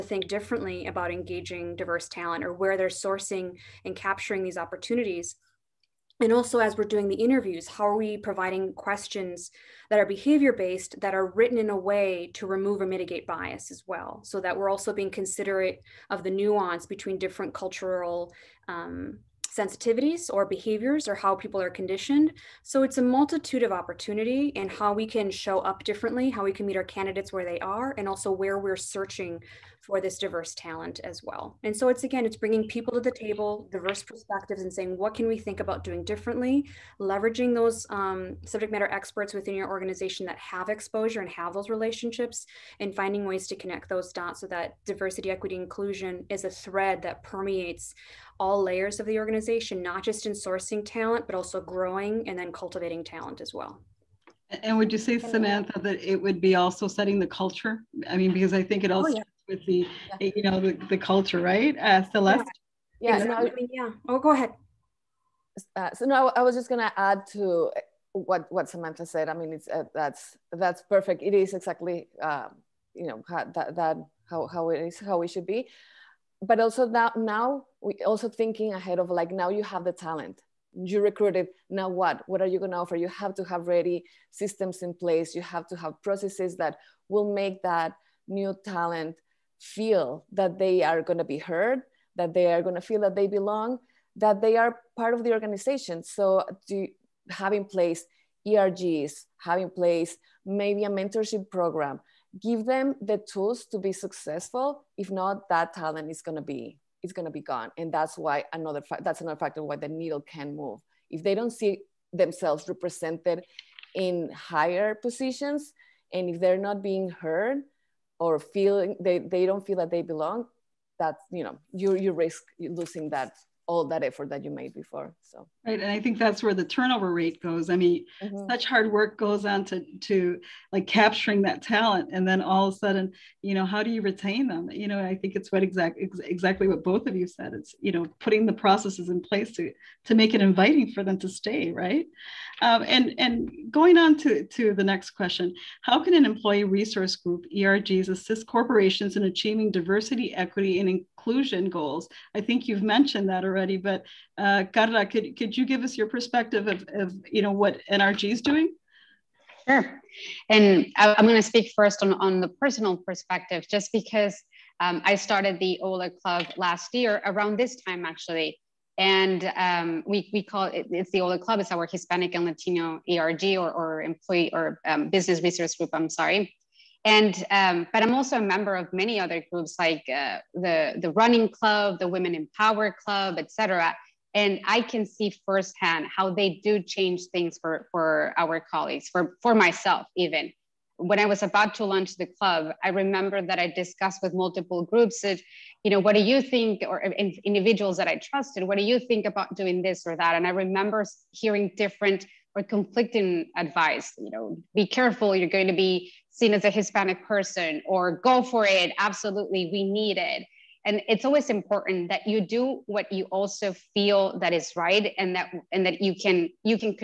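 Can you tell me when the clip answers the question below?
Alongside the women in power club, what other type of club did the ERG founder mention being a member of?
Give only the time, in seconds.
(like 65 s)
181 s.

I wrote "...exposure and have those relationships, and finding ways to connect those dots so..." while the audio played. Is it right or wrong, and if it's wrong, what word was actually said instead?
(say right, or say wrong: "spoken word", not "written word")
right.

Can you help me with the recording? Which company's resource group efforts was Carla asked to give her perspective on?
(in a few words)
NRG.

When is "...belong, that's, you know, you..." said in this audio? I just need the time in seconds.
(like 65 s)
120 s.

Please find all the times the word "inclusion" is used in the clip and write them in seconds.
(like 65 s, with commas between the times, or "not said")
45 s, 151 s.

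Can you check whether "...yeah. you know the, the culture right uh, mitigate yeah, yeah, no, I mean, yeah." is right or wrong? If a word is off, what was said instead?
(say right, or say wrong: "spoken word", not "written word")
wrong: "celeste", not "mitigate".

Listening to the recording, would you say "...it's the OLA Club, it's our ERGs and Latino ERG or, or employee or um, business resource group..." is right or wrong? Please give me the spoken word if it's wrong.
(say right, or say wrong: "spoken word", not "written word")
wrong: "Hispanic", not "ERGs".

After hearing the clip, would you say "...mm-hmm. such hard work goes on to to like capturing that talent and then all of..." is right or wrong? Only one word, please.
right.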